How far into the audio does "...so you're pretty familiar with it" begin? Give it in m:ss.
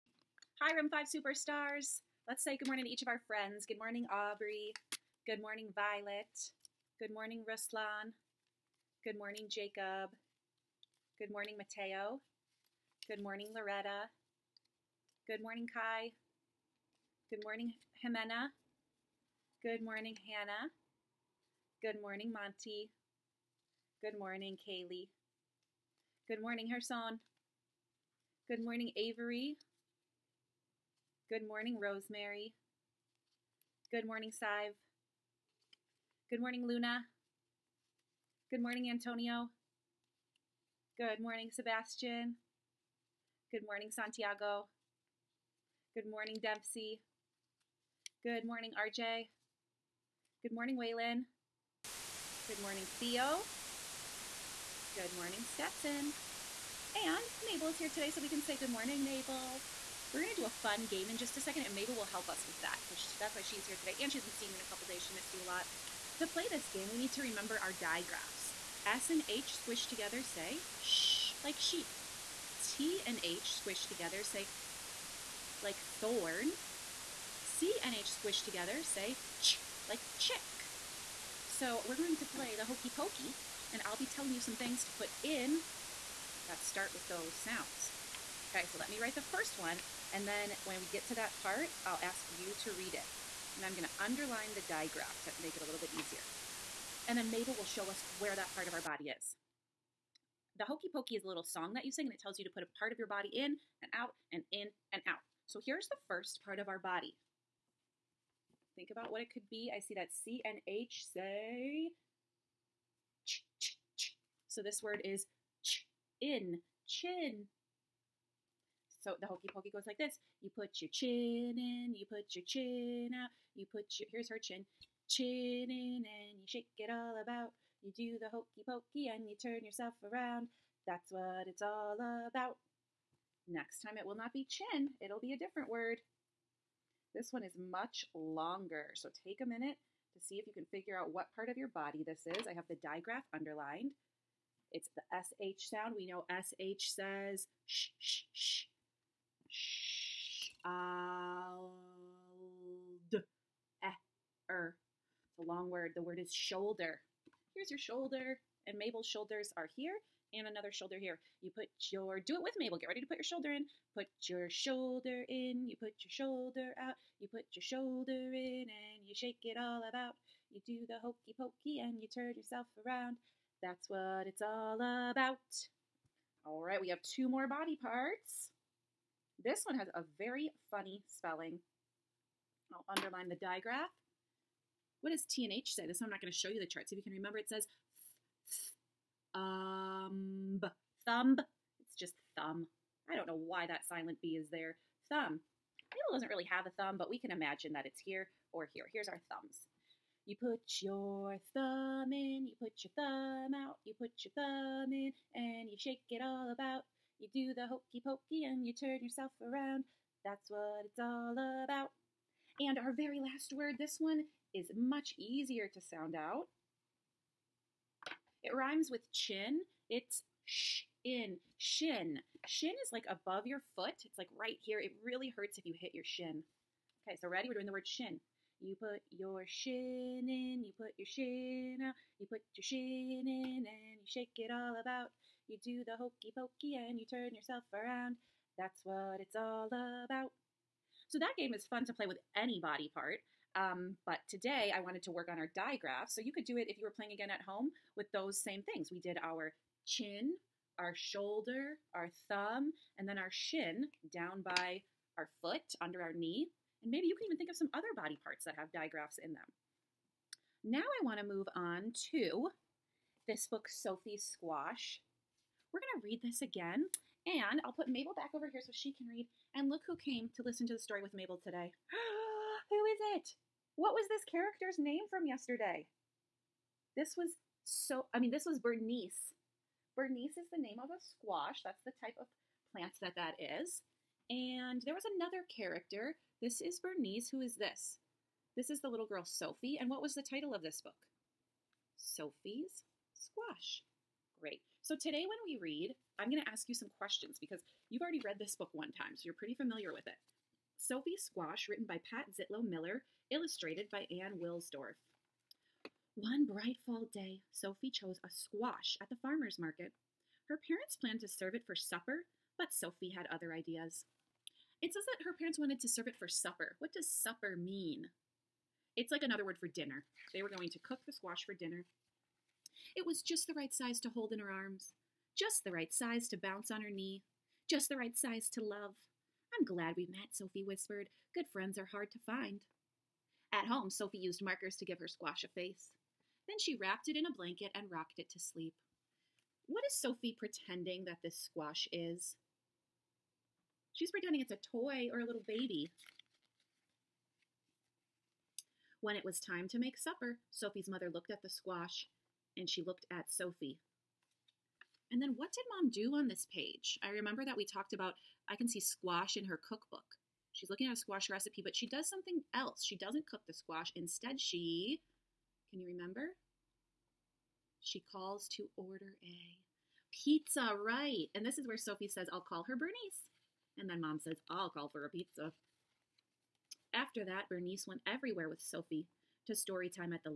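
4:59.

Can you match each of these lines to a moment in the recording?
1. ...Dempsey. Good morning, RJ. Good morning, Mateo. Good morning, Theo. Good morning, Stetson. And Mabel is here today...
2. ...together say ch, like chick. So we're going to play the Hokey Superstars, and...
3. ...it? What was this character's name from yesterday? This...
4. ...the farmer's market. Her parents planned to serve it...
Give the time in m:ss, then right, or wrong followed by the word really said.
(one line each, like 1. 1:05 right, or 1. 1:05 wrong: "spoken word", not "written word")
1. 0:46 wrong: "Waylon", not "Mateo"
2. 1:18 wrong: "Pokey", not "Superstars"
3. 4:33 right
4. 5:09 right.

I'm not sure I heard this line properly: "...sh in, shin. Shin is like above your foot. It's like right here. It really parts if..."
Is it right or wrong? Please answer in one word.
wrong.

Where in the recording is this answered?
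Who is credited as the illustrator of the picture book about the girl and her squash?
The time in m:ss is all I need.
5:03.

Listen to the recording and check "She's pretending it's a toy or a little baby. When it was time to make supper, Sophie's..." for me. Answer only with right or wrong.
right.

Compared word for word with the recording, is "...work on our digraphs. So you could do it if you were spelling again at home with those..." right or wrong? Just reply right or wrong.
wrong.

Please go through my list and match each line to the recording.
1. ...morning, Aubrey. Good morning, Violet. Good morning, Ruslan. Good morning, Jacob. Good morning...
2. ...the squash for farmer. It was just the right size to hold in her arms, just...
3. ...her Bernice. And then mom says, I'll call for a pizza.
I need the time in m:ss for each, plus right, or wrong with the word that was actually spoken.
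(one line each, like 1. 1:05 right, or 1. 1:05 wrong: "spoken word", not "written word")
1. 0:03 right
2. 5:21 wrong: "dinner", not "farmer"
3. 6:12 right.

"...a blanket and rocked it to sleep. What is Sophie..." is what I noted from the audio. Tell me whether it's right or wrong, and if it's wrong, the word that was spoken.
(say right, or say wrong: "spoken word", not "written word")
right.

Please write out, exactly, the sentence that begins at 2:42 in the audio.
Get ready to put your shoulder in.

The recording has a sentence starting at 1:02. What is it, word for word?
So she, that's why she's here today, and she hasn't seen you in a couple days.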